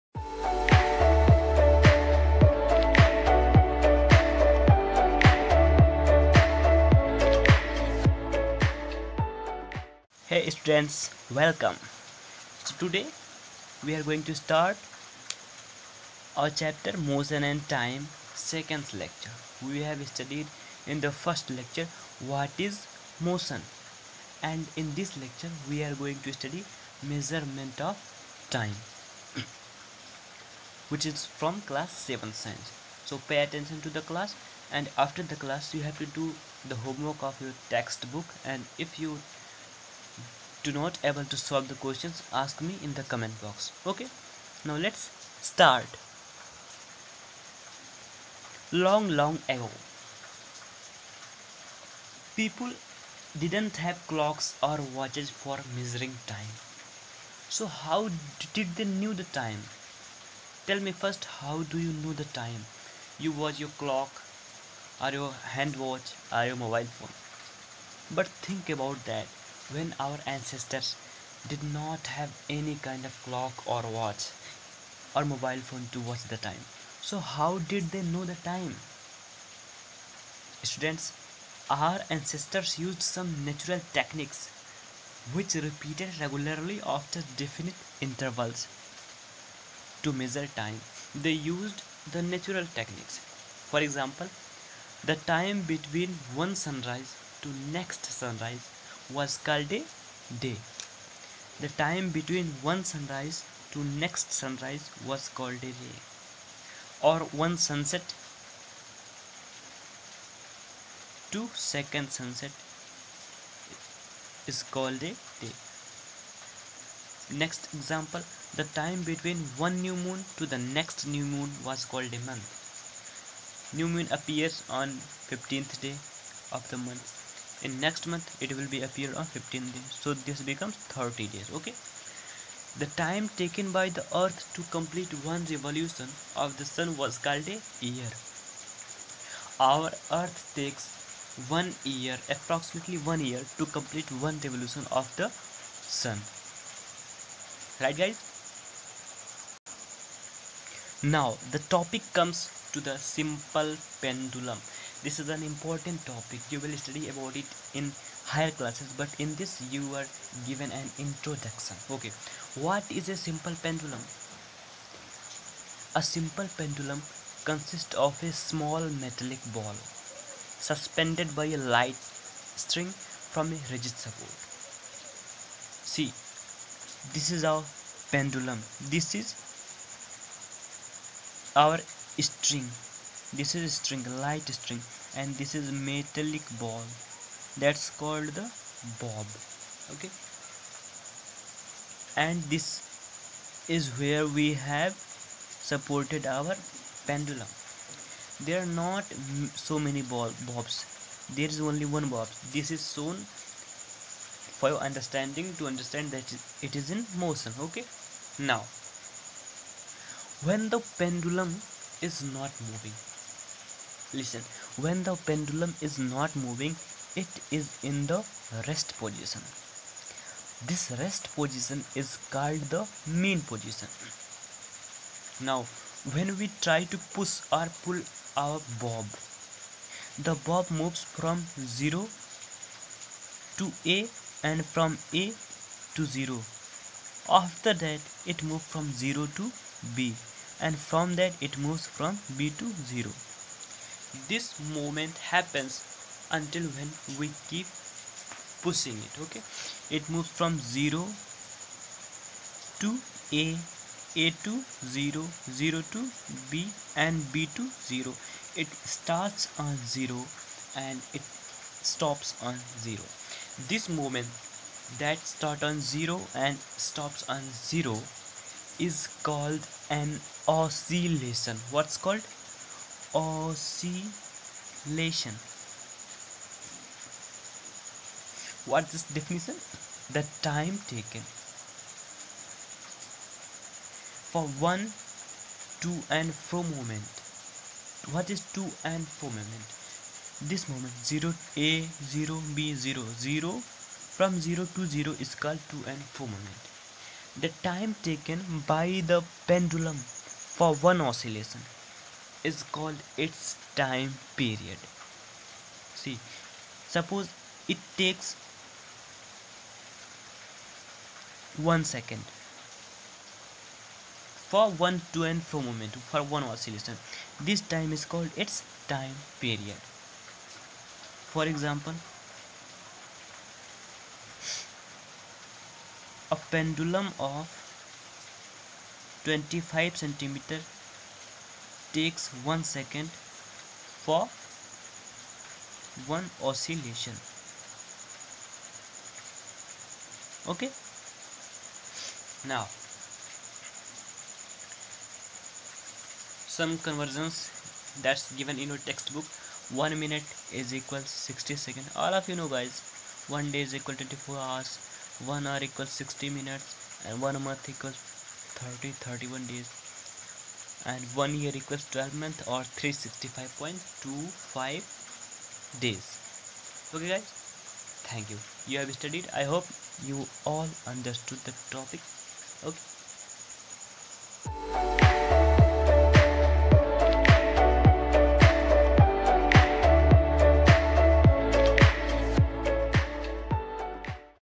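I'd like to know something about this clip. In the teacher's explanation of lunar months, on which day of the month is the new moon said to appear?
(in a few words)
15th day.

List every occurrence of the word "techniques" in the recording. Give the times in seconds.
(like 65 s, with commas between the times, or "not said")
83 s, 92 s.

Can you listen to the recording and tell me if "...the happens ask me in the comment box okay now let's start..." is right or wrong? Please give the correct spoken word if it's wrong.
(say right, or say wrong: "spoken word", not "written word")
wrong: "questions", not "happens".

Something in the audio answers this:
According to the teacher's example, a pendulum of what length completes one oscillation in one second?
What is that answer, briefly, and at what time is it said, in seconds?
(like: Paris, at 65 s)
25 centimeters, at 329 s.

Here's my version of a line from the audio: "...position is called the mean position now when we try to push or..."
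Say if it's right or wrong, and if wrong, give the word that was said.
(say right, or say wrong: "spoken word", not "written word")
right.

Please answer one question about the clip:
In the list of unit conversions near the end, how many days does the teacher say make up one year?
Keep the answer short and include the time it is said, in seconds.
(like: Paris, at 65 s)
365.25 days, at 362 s.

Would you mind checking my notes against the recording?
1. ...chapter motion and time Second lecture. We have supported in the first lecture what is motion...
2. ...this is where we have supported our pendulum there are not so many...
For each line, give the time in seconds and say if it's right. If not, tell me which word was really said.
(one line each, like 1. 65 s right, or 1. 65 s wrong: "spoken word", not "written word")
1. 16 s wrong: "studied", not "supported"
2. 192 s right.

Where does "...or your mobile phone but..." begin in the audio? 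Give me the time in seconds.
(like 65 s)
66 s.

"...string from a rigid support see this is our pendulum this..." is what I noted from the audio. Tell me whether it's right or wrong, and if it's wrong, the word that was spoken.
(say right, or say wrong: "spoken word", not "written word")
right.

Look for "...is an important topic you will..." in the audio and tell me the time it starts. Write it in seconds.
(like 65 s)
155 s.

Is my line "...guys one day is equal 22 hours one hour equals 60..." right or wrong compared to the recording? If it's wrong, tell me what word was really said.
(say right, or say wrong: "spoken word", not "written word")
wrong: "24", not "22".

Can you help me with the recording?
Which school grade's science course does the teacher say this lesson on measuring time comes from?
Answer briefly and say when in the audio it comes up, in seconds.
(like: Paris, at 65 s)
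Class 7, at 31 s.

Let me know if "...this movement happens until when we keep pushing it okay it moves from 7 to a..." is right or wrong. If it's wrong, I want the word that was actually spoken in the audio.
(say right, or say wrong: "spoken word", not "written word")
wrong: "0", not "7".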